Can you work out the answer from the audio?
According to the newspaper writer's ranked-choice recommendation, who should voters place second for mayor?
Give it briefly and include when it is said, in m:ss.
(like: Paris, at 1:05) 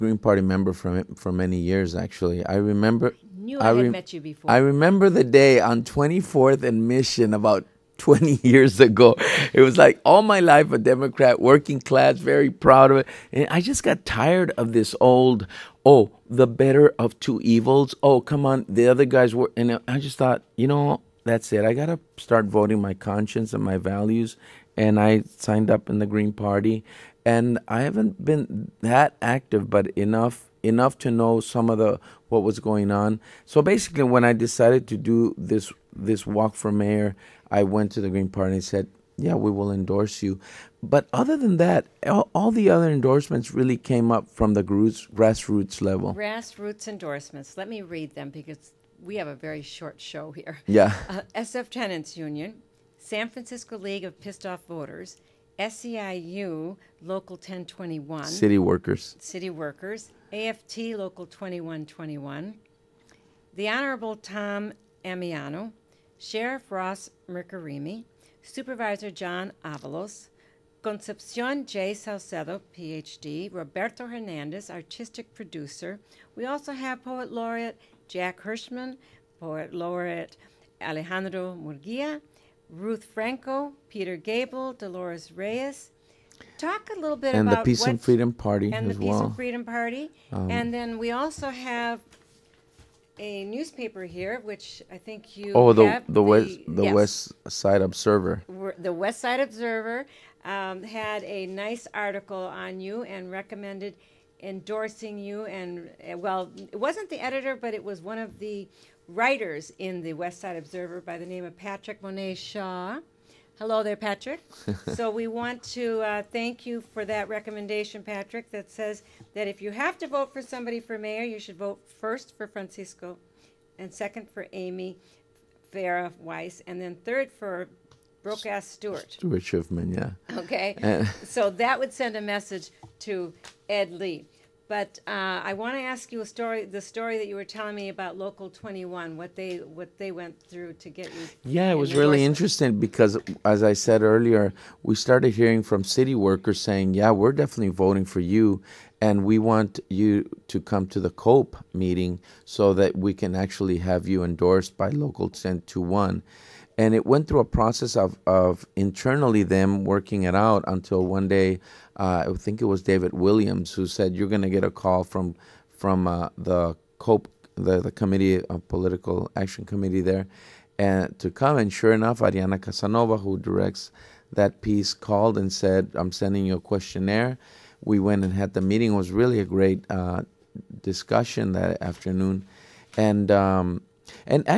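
Amy Farah Weiss, at 2:04.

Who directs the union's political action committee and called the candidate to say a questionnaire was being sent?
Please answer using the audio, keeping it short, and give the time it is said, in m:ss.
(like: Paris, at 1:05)
Ariana Casanova, at 2:52.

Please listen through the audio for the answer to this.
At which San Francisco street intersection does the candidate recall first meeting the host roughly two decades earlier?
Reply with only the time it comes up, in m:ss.
0:05.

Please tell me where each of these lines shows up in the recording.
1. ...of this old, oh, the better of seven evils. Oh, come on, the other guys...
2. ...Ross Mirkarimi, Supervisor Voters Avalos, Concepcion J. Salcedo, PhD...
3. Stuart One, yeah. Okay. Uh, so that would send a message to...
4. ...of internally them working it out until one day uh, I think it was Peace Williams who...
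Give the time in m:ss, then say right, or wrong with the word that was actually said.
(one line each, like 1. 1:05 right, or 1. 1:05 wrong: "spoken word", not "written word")
1. 0:14 wrong: "two", not "seven"
2. 1:06 wrong: "John", not "Voters"
3. 2:09 wrong: "Schuffman", not "One"
4. 2:38 wrong: "David", not "Peace".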